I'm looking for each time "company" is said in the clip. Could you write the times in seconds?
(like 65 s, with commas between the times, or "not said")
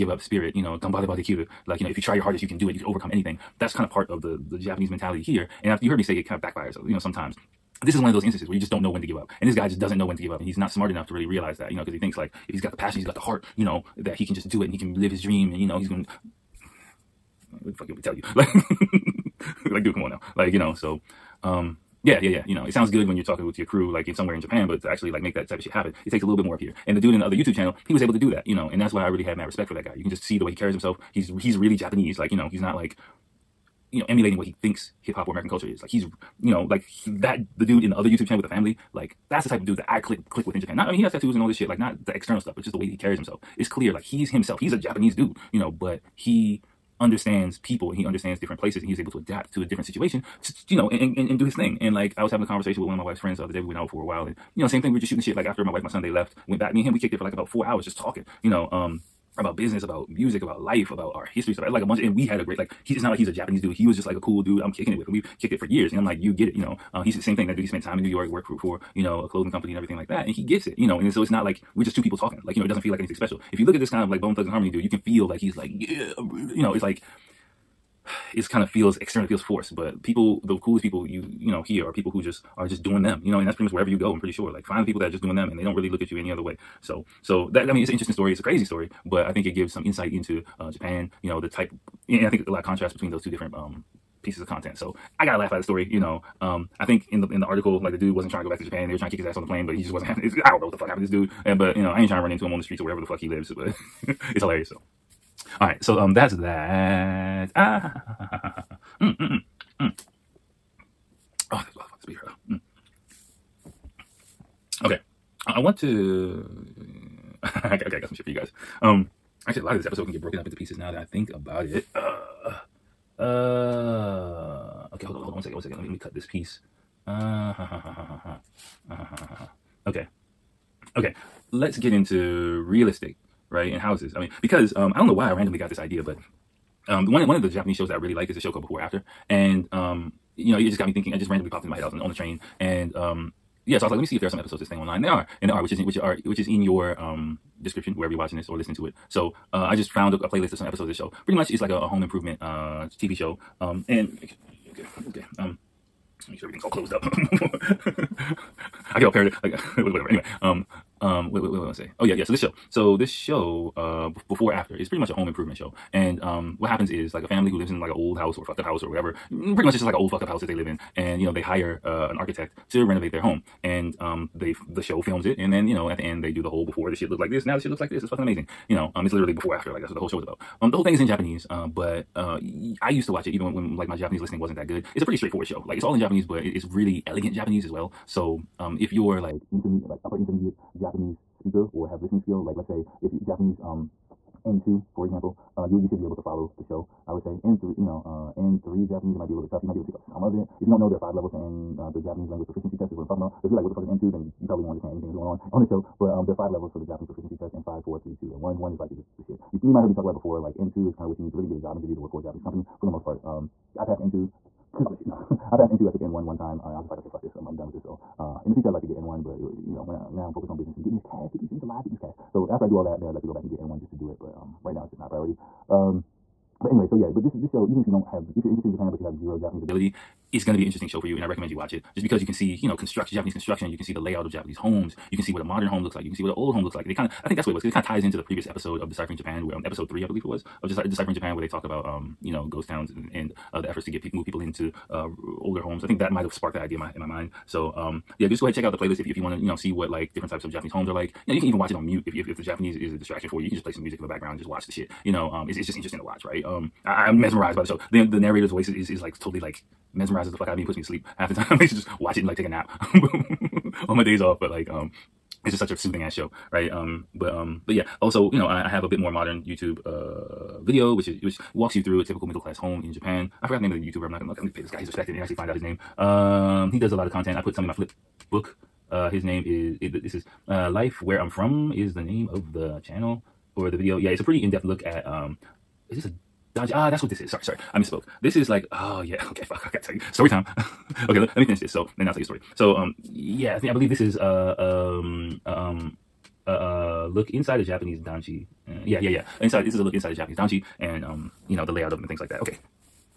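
69 s, 212 s.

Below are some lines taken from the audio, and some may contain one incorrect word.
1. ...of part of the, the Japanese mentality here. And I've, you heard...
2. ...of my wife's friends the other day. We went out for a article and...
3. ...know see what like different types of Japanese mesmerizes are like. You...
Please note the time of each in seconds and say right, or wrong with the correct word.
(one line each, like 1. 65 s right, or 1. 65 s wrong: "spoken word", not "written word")
1. 3 s right
2. 52 s wrong: "while", not "article"
3. 249 s wrong: "homes", not "mesmerizes".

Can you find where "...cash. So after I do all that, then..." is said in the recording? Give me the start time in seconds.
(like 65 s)
221 s.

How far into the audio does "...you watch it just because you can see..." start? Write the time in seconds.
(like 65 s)
231 s.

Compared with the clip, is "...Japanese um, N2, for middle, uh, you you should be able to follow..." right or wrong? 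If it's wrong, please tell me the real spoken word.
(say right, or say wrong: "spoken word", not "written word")
wrong: "example", not "middle".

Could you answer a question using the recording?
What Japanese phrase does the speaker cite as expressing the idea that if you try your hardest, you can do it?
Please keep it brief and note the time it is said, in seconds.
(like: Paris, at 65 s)
gambareba dekiru, at 0 s.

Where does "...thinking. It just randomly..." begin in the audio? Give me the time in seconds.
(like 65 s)
140 s.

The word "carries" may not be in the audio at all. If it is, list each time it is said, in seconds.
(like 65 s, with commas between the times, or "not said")
30 s, 42 s.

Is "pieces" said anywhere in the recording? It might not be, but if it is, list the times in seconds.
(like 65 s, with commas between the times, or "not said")
94 s, 120 s, 126 s.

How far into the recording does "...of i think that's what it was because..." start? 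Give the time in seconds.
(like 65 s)
237 s.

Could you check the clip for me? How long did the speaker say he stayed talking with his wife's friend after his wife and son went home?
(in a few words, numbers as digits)
about four hours.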